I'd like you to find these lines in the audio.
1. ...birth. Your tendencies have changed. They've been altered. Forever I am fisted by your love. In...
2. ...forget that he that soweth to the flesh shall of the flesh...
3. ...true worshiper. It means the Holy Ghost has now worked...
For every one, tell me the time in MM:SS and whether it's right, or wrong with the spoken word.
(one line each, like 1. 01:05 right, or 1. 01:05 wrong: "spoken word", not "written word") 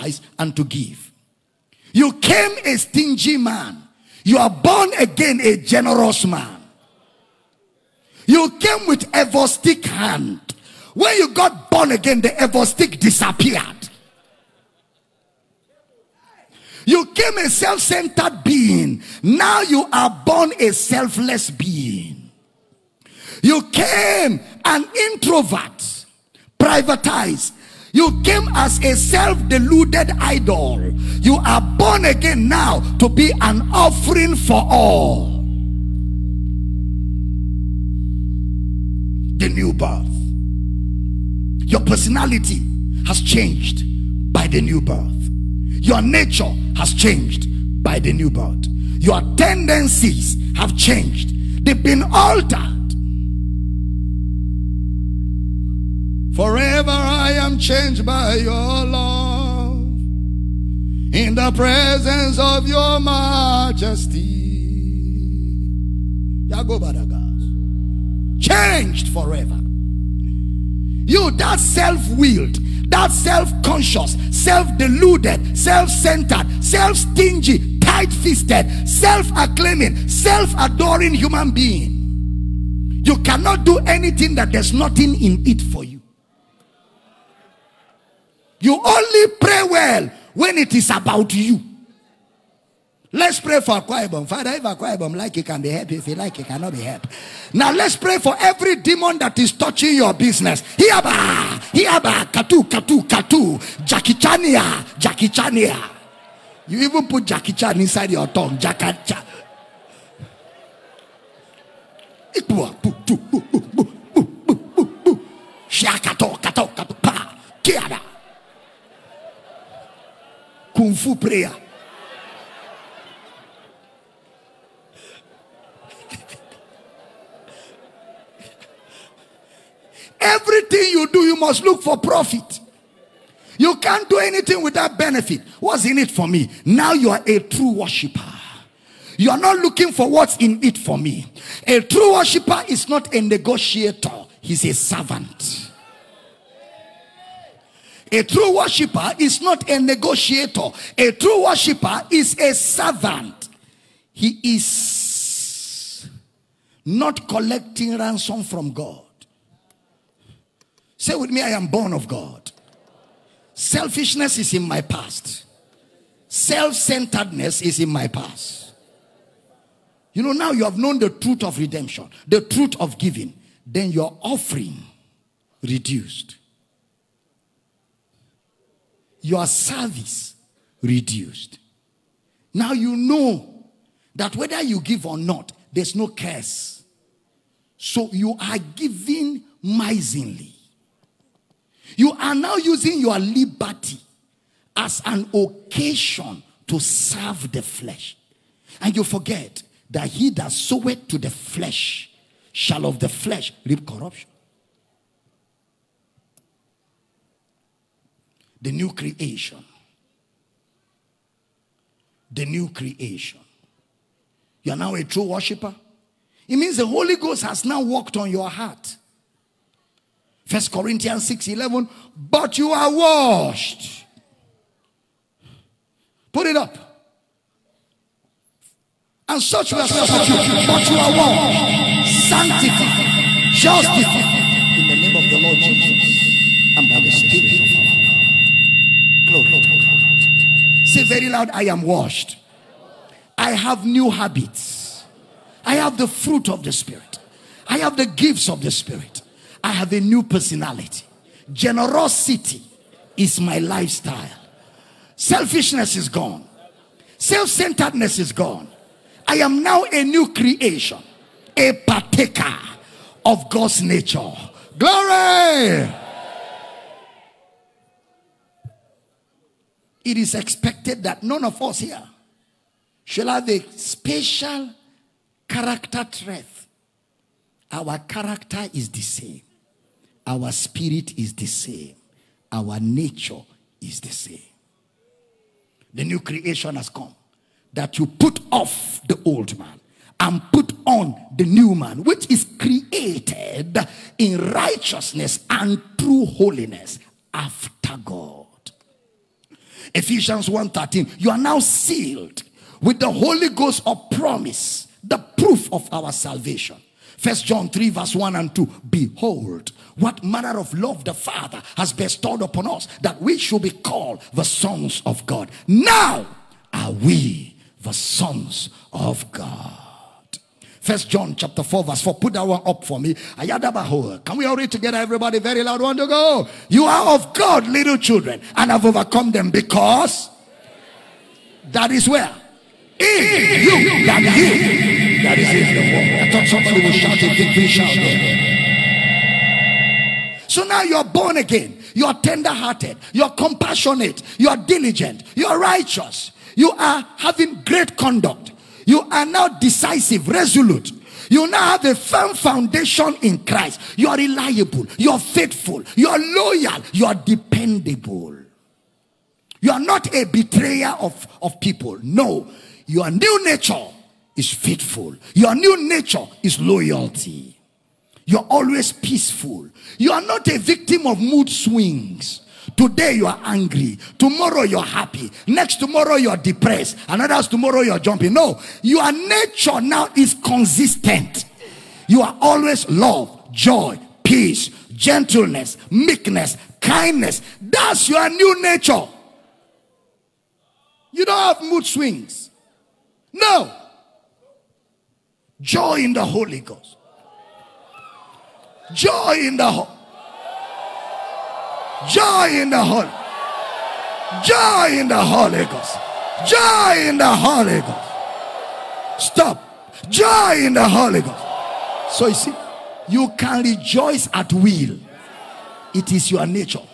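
1. 00:48 wrong: "changed", not "fisted"
2. 03:19 right
3. 03:35 right.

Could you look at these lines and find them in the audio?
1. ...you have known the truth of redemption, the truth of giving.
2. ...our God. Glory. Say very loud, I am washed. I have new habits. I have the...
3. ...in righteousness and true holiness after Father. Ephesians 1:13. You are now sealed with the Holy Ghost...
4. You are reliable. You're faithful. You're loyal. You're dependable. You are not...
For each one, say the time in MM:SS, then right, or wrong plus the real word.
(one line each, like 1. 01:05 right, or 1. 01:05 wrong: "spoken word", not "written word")
1. 02:50 right
2. 03:59 right
3. 04:54 wrong: "God", not "Father"
4. 05:53 right.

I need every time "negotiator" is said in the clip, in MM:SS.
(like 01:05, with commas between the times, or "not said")
02:23, 02:29.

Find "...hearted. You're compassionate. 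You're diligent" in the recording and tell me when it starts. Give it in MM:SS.
05:42.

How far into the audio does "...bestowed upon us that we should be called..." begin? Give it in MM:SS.
05:11.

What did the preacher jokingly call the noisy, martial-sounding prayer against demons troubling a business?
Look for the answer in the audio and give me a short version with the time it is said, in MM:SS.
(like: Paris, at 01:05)
Kung Fu prayer, at 02:00.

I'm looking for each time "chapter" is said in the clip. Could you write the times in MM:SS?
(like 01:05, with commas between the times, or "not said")
05:21.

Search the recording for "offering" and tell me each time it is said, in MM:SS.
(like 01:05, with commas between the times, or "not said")
00:33, 02:54.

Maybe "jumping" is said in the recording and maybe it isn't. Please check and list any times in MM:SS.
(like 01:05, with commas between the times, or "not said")
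06:17.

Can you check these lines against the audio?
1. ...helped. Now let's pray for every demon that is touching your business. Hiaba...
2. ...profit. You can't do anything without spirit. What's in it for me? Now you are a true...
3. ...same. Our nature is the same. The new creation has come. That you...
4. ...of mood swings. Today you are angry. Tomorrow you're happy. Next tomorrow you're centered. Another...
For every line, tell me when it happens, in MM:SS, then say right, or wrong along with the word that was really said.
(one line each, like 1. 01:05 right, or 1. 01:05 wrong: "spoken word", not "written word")
1. 01:36 right
2. 02:11 wrong: "benefit", not "spirit"
3. 04:41 right
4. 06:11 wrong: "depressed", not "centered".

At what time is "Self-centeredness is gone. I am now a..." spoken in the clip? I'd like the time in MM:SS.
04:17.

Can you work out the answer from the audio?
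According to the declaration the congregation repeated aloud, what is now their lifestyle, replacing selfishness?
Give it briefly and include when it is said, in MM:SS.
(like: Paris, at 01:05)
Generosity, at 04:11.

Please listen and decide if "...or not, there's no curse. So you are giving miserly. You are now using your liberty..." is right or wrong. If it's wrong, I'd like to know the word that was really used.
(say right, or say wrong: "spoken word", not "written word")
right.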